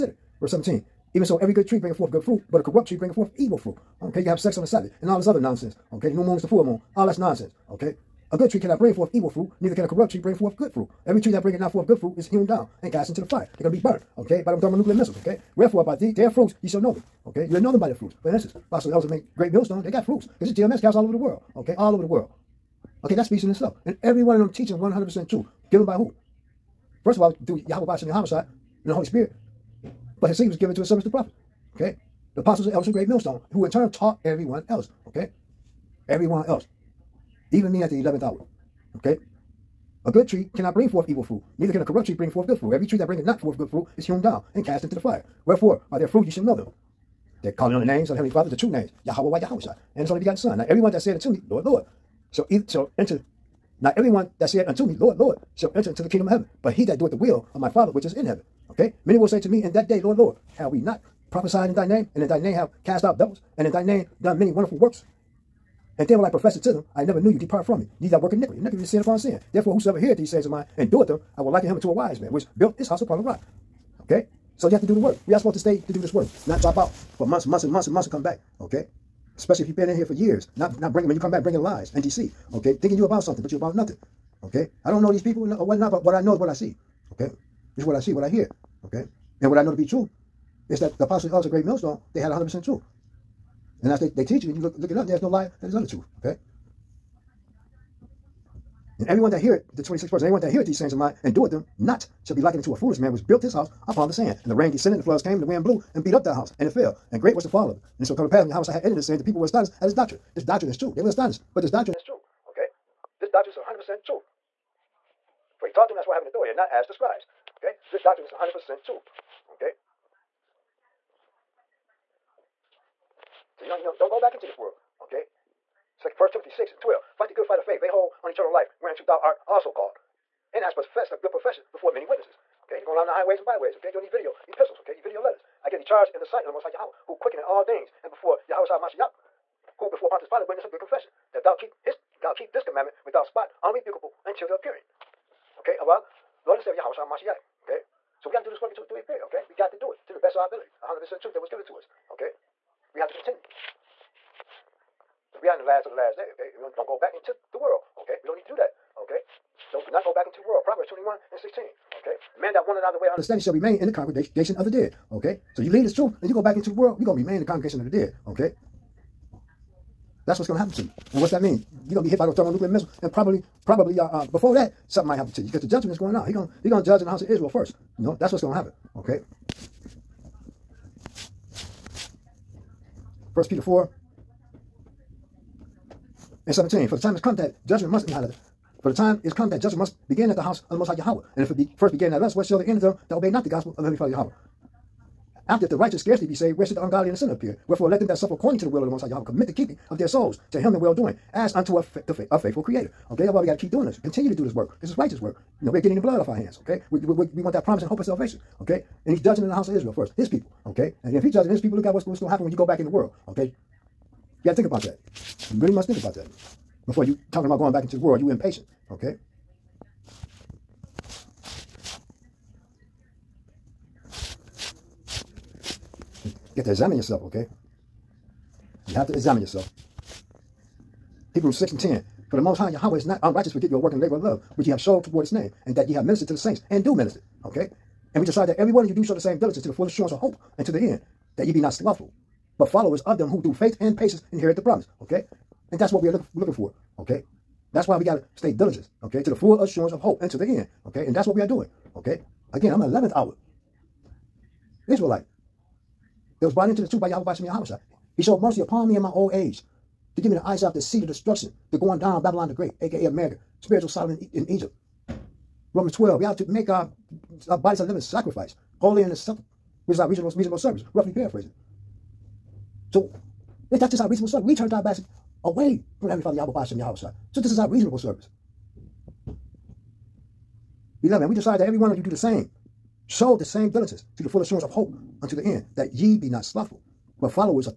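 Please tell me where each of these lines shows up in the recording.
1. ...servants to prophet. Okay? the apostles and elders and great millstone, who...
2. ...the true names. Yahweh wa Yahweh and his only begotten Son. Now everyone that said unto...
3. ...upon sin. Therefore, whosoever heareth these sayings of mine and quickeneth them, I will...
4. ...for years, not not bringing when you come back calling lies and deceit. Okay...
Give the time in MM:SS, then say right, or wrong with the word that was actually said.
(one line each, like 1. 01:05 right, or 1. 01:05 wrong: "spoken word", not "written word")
1. 00:30 right
2. 00:48 right
3. 01:09 wrong: "doeth", not "quickeneth"
4. 01:20 wrong: "bringing", not "calling".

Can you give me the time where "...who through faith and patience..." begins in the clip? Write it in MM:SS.
04:03.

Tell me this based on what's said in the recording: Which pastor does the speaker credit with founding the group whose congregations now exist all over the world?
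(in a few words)
Pastor Ellison.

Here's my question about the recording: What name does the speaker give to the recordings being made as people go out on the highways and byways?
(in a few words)
video epistles.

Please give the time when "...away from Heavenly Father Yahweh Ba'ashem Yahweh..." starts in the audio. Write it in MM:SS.
04:35.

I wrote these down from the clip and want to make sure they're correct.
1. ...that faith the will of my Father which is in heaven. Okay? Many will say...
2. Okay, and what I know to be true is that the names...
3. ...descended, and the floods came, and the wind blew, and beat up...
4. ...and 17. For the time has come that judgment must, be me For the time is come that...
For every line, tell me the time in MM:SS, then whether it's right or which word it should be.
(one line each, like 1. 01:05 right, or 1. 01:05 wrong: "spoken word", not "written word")
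1. 00:56 wrong: "doeth", not "faith"
2. 01:28 wrong: "apostles", not "names"
3. 01:44 right
4. 03:06 right.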